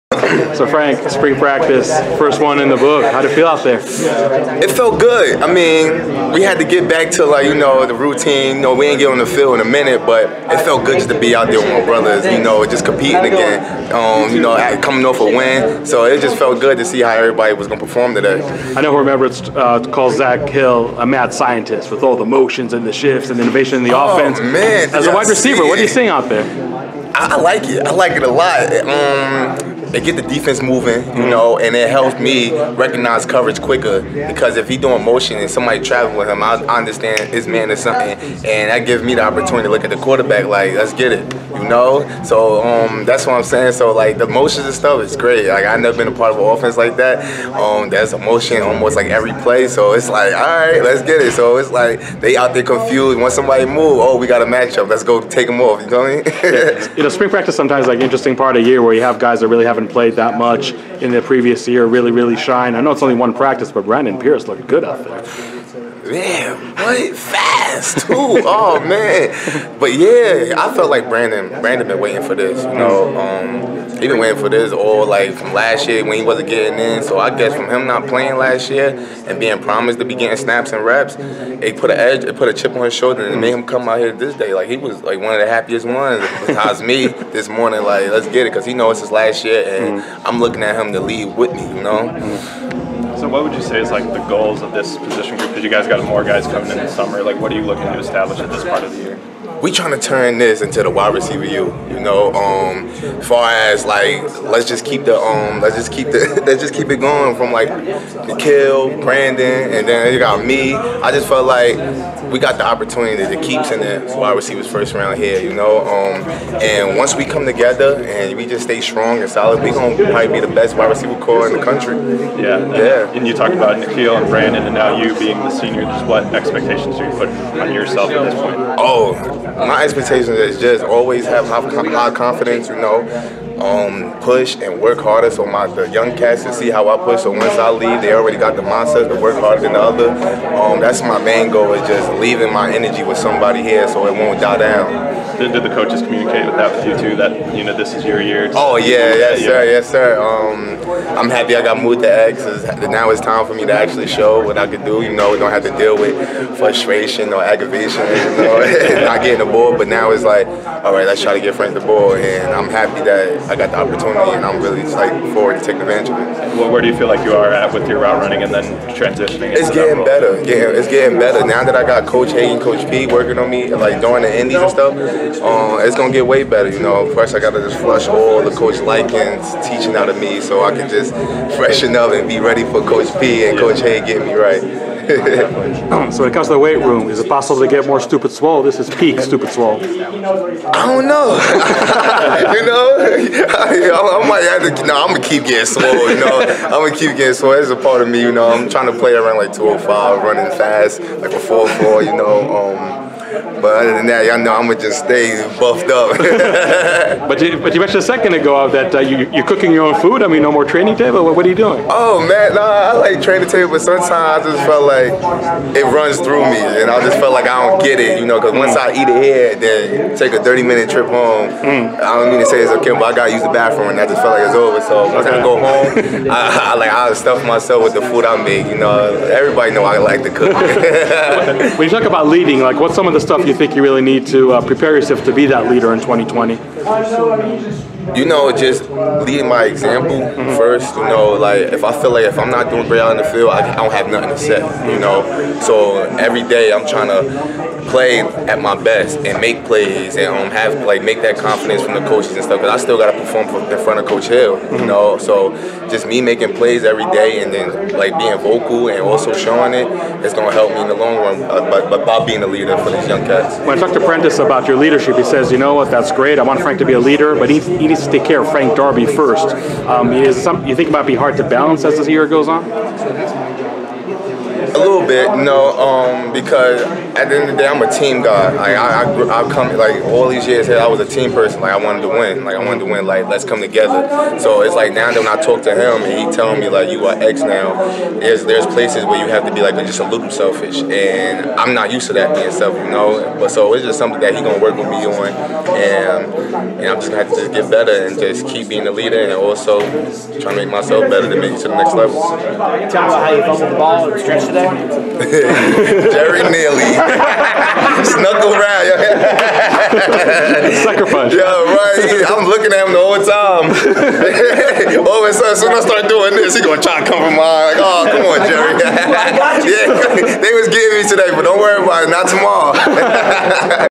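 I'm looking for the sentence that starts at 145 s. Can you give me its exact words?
Did, did the coaches communicate with that with you too?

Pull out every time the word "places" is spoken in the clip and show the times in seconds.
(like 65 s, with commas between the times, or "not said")
288 s.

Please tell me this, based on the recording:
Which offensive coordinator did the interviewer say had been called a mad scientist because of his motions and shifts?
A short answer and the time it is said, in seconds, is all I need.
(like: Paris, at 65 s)
Zak Hill, at 20 s.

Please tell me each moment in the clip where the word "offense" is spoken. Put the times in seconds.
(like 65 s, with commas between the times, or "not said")
24 s, 46 s.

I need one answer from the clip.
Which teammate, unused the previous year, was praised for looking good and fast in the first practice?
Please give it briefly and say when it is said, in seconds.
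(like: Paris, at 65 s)
Brandon Pierce, at 63 s.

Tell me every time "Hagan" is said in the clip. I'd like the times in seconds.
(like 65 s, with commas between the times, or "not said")
172 s, 183 s.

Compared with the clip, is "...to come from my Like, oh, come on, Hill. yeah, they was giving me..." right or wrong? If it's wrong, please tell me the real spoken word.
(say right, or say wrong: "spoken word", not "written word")
wrong: "Jerry", not "Hill".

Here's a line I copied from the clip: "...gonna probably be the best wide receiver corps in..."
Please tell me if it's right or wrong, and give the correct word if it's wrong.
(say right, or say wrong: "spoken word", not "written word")
right.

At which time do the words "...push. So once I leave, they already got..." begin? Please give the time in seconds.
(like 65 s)
137 s.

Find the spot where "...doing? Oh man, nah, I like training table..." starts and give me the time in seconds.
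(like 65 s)
211 s.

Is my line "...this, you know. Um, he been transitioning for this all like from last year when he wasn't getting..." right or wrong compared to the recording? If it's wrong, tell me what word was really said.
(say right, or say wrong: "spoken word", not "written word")
wrong: "waiting", not "transitioning".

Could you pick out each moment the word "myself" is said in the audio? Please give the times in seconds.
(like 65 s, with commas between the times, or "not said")
227 s, 300 s.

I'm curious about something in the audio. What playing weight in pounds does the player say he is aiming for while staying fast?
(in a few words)
205.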